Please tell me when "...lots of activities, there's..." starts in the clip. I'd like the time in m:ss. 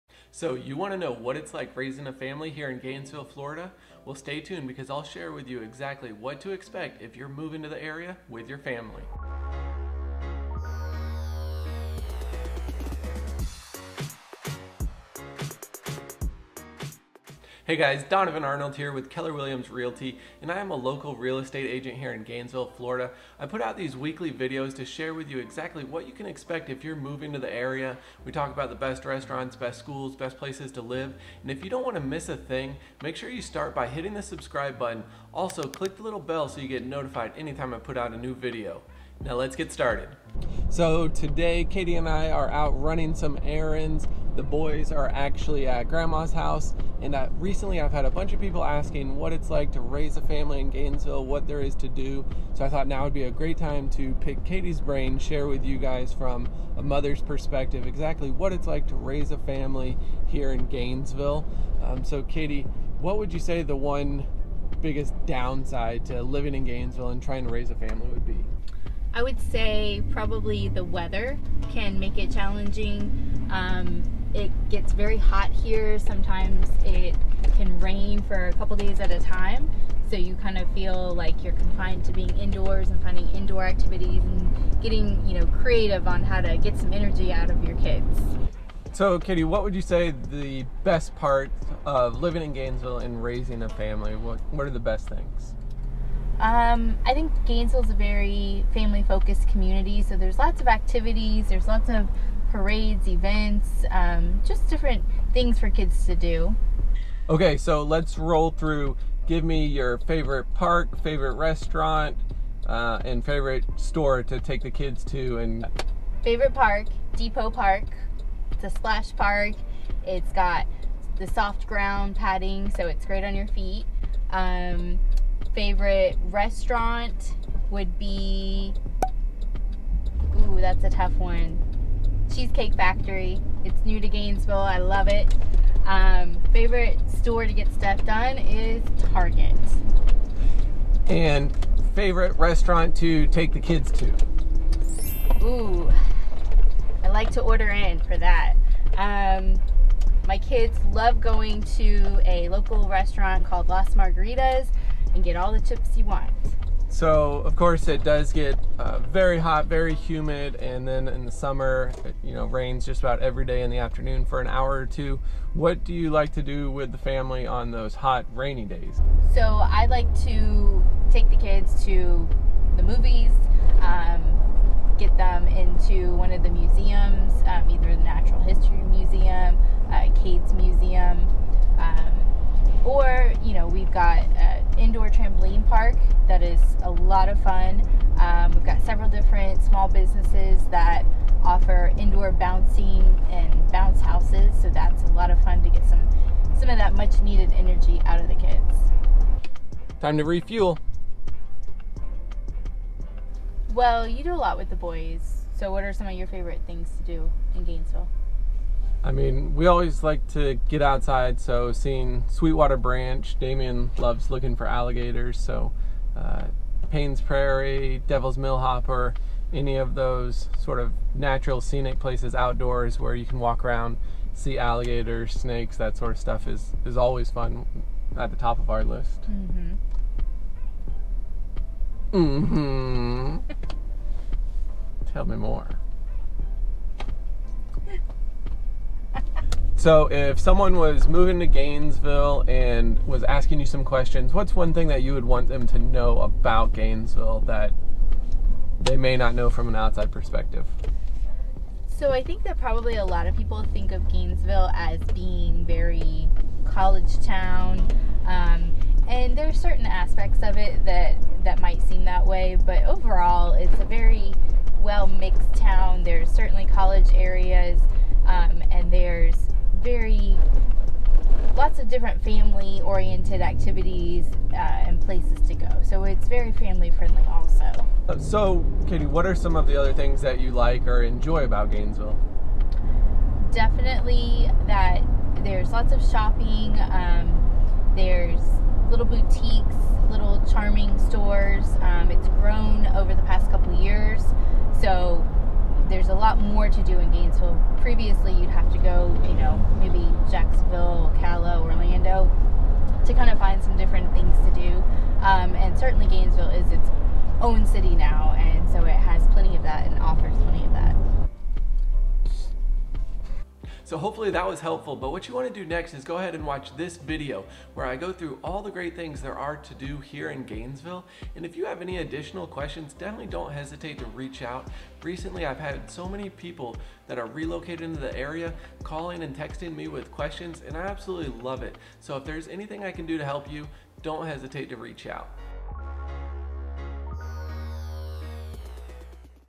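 1:40.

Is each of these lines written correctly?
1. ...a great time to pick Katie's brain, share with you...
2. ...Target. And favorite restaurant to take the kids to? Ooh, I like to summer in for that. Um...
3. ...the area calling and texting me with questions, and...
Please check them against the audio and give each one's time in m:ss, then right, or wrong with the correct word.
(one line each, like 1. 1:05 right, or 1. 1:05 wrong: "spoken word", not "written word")
1. 0:53 right
2. 2:19 wrong: "order", not "summer"
3. 5:27 right.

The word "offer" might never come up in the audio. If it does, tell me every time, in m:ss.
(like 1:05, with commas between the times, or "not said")
3:11, 5:09.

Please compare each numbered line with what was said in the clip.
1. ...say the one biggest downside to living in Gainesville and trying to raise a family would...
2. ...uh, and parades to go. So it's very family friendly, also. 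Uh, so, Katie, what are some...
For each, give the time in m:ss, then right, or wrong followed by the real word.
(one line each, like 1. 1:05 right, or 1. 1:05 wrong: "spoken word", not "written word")
1. 1:03 right
2. 4:34 wrong: "places", not "parades".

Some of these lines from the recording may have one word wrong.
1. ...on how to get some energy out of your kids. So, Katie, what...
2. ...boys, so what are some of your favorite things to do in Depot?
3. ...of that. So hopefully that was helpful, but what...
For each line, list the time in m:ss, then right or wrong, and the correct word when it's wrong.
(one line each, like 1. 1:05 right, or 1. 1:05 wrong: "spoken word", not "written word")
1. 1:26 right
2. 3:24 wrong: "Gainesville", not "Depot"
3. 5:10 right.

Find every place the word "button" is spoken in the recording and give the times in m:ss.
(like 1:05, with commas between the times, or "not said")
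0:34.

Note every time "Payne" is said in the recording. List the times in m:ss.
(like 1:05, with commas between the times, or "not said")
3:36.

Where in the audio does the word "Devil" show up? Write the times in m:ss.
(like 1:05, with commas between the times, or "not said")
3:38.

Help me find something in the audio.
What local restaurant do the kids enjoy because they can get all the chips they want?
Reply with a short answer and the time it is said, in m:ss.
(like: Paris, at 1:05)
Las Margaritas, at 2:33.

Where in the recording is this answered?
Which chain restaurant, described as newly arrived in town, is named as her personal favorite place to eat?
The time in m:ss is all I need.
2:12.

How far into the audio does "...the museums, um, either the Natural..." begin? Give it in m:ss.
2:56.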